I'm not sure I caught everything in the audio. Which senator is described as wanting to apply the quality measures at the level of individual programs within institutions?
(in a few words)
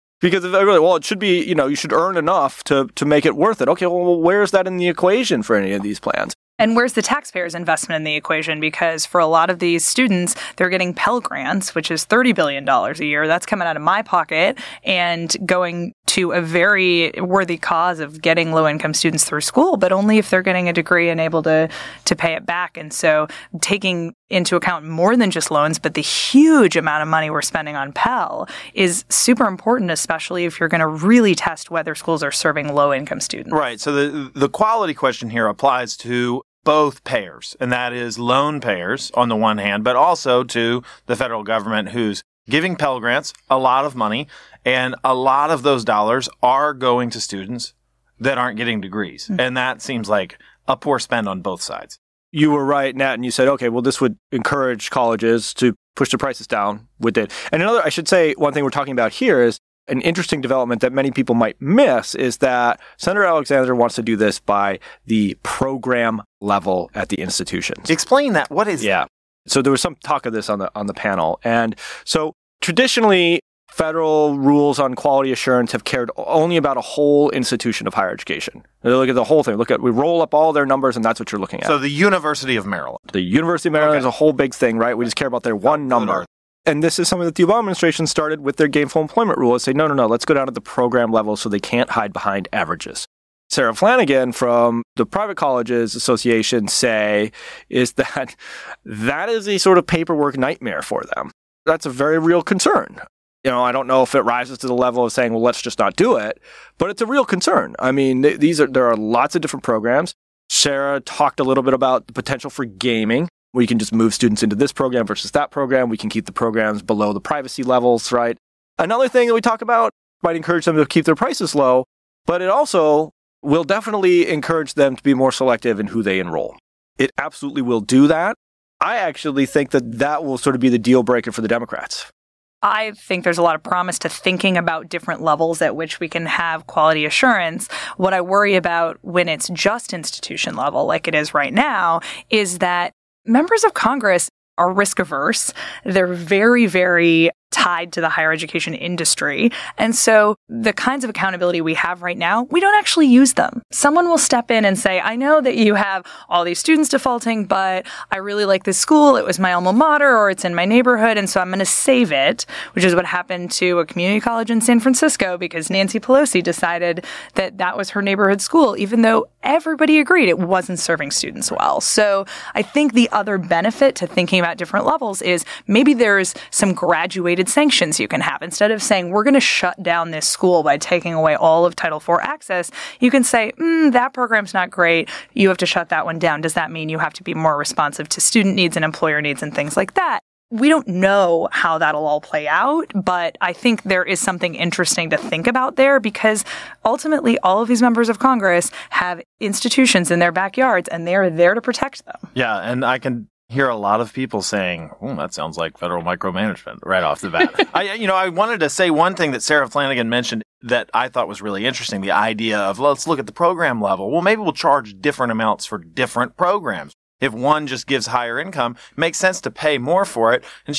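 Senator Alexander.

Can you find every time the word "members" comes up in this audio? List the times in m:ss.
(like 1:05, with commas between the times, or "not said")
2:23, 3:17.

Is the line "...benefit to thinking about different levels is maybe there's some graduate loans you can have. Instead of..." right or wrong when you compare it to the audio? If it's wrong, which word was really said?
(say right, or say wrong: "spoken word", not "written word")
wrong: "sanctions", not "loans".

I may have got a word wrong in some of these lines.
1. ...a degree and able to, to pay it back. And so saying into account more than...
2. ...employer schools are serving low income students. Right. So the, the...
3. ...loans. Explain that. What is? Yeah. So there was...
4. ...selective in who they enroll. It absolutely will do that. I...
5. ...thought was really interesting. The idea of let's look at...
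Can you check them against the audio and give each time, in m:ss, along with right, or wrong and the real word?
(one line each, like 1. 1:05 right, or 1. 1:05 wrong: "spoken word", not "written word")
1. 0:20 wrong: "taking", not "saying"
2. 0:31 wrong: "whether", not "employer"
3. 1:07 wrong: "institutions", not "loans"
4. 2:05 right
5. 3:31 right.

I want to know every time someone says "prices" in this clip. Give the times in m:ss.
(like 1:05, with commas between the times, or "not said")
0:56, 2:01.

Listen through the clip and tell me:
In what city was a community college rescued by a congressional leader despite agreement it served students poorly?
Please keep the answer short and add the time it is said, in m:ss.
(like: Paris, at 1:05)
San Francisco, at 2:44.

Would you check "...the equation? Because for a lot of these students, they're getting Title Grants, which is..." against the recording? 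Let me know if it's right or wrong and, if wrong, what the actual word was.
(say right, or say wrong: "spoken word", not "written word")
wrong: "Pell", not "Title".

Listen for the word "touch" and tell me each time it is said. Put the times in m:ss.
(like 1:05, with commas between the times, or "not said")
not said.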